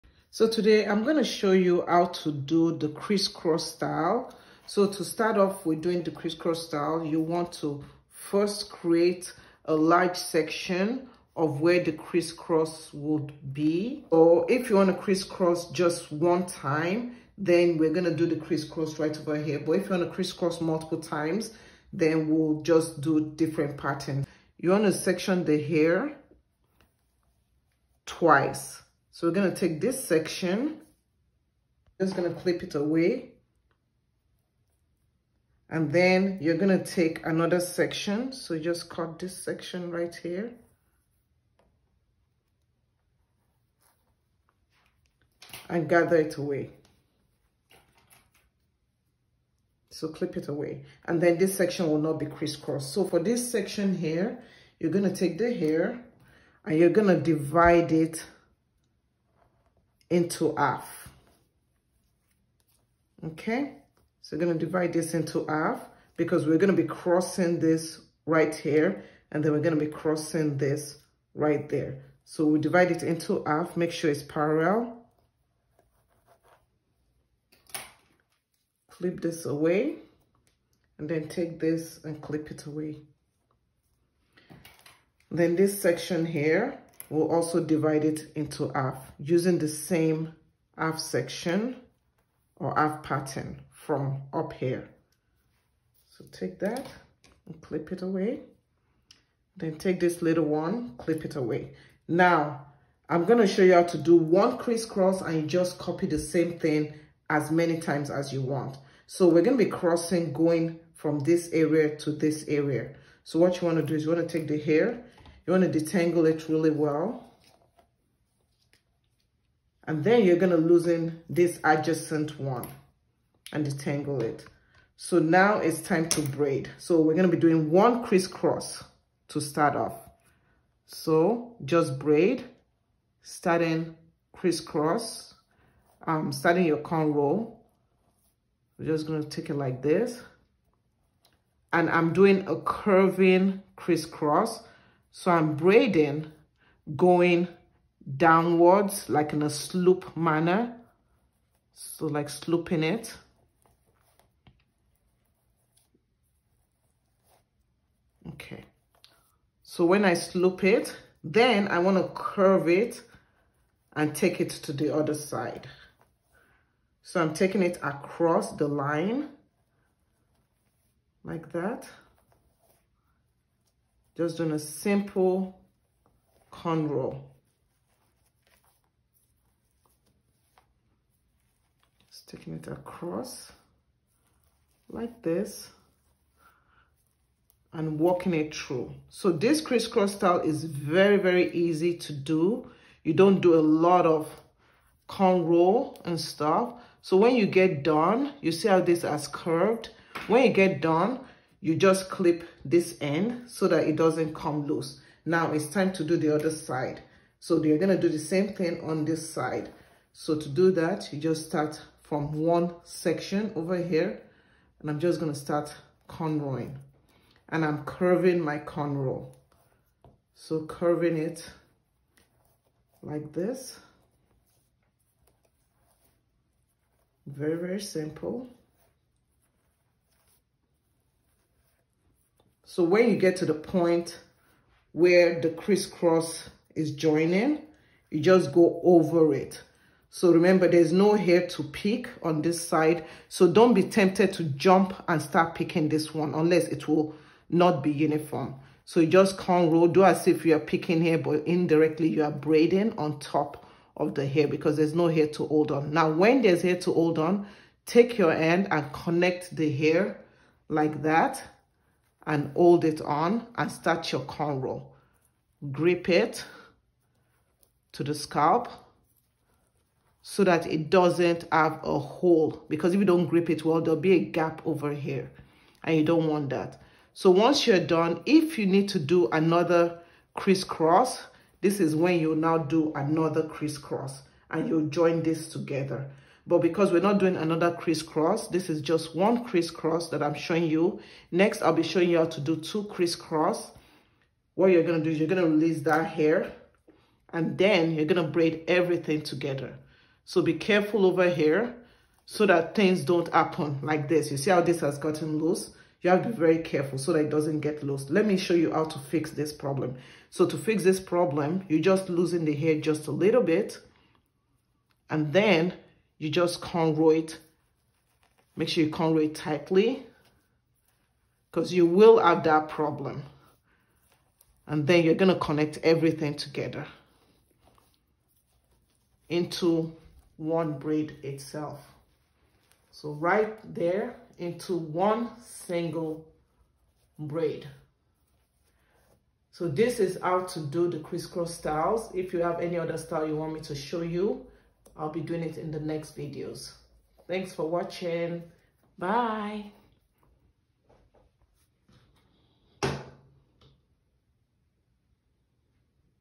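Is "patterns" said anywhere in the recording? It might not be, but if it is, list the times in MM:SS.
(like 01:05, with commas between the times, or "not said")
00:23, 01:33.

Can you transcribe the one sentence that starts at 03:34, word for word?
And I'm just going to start cornrowing.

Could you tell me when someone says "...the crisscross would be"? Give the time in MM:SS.
00:11.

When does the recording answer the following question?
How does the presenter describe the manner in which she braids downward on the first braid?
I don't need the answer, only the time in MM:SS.
02:29.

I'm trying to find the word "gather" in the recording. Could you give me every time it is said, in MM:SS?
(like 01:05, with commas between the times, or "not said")
00:45.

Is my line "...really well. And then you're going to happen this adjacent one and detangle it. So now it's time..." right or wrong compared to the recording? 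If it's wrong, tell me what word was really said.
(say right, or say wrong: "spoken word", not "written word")
wrong: "loosen", not "happen".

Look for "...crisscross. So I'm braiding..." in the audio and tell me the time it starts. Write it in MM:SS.
02:23.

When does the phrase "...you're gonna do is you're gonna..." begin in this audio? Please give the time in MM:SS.
04:54.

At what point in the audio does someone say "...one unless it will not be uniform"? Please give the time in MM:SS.
04:06.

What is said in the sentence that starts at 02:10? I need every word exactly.
So just braid, starting crisscross, um, starting your cornrow.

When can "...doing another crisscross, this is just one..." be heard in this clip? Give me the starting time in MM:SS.
04:47.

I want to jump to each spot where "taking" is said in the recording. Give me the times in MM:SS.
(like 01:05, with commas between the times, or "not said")
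02:47, 03:02.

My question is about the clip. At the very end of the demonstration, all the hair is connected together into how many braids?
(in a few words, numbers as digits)
1.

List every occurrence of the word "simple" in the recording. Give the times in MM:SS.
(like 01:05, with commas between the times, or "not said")
02:54, 03:47.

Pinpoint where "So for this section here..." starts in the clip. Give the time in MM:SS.
00:52.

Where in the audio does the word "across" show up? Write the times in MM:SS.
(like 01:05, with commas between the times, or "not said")
02:47, 03:02.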